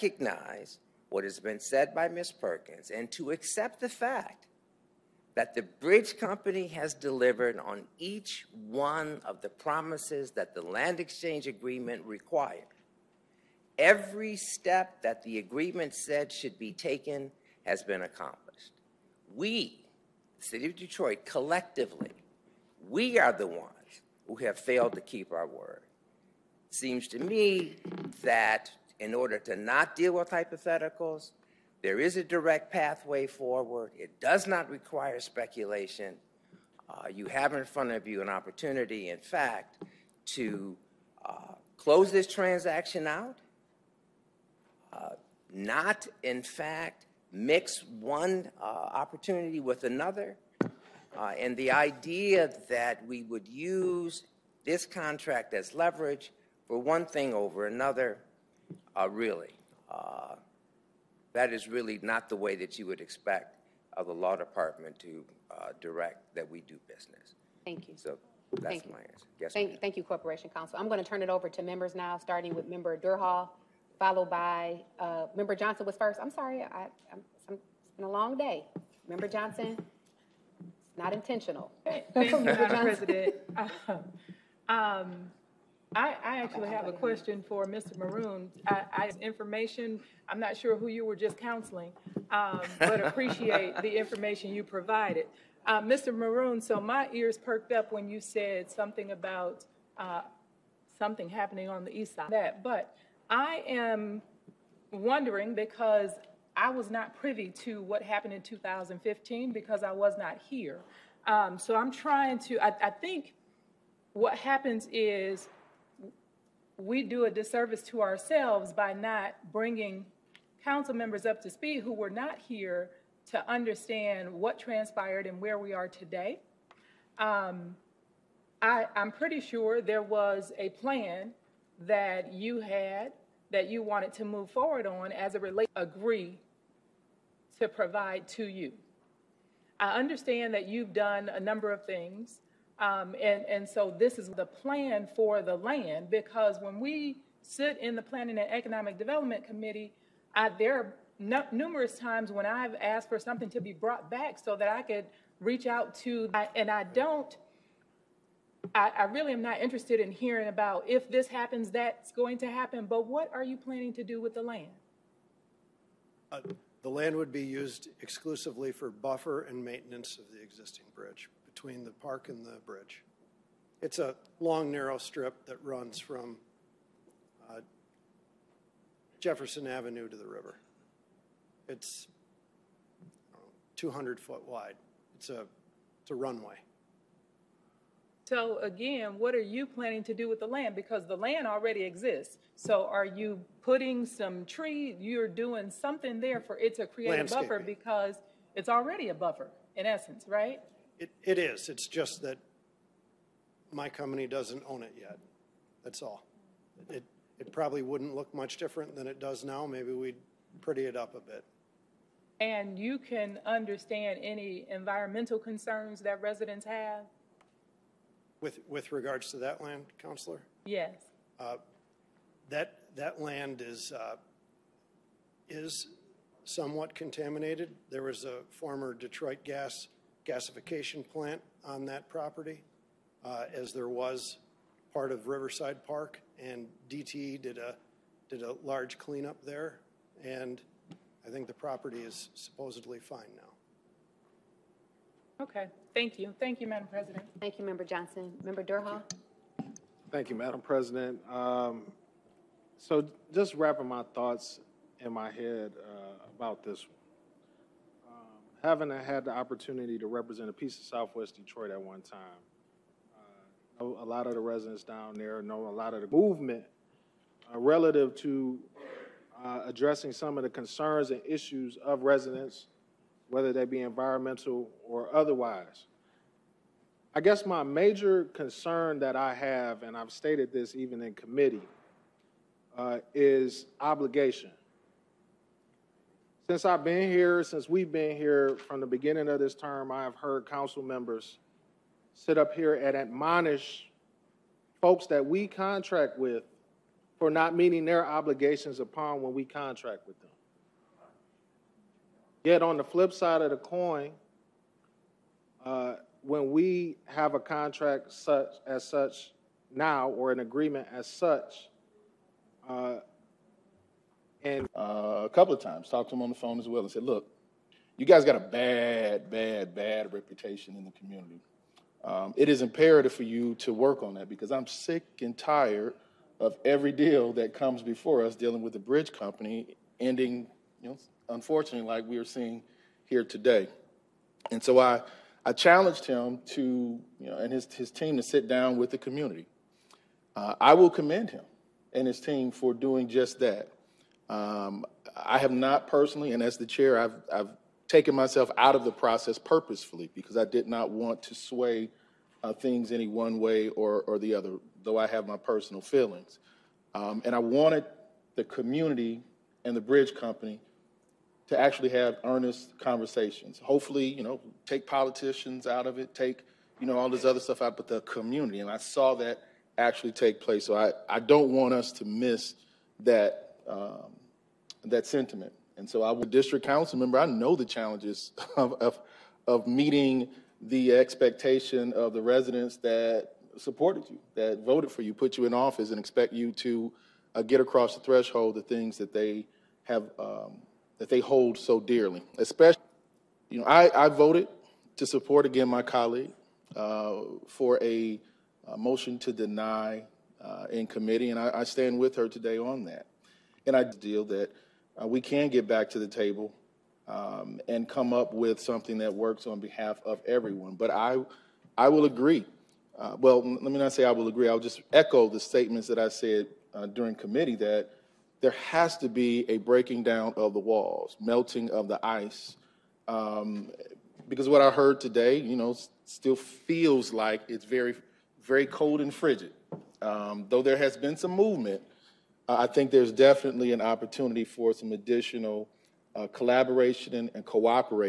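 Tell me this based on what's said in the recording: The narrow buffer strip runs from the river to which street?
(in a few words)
Jefferson Avenue.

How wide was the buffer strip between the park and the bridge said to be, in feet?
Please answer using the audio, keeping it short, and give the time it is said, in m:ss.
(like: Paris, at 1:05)
200, at 3:03.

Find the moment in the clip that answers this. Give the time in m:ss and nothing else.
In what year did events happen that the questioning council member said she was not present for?
1:48.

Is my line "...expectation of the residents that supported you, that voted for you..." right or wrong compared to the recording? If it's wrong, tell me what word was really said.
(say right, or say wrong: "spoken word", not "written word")
right.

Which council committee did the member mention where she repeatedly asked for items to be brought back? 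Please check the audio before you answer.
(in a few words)
Planning and Economic Development Committee.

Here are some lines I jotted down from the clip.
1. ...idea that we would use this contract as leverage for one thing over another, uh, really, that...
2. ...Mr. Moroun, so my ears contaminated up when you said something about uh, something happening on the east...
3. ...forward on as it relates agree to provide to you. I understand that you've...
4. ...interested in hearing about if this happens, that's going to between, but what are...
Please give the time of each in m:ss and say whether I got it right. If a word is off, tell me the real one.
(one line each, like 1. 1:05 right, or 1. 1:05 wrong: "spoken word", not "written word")
1. 0:51 right
2. 1:35 wrong: "perked", not "contaminated"
3. 2:14 right
4. 2:39 wrong: "happen", not "between".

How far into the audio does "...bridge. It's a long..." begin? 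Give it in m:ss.
2:52.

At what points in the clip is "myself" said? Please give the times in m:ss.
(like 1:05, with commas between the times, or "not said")
5:48.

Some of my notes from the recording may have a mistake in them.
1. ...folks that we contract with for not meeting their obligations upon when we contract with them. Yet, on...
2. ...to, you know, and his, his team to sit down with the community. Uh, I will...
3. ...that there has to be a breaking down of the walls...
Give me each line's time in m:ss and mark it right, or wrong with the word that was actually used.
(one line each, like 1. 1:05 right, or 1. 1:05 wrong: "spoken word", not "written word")
1. 4:54 right
2. 5:36 right
3. 6:57 right.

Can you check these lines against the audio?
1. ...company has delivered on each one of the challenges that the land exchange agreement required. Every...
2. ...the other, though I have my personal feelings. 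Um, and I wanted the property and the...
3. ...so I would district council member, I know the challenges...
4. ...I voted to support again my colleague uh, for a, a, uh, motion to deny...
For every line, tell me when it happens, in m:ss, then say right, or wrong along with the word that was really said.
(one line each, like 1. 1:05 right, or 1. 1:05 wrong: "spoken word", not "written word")
1. 0:06 wrong: "promises", not "challenges"
2. 5:54 wrong: "community", not "property"
3. 6:15 right
4. 6:34 right.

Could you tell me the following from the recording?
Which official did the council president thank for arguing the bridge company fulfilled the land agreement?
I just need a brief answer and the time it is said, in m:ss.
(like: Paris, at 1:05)
Corporation Counsel, at 1:10.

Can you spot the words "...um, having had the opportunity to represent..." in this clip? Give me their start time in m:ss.
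4:18.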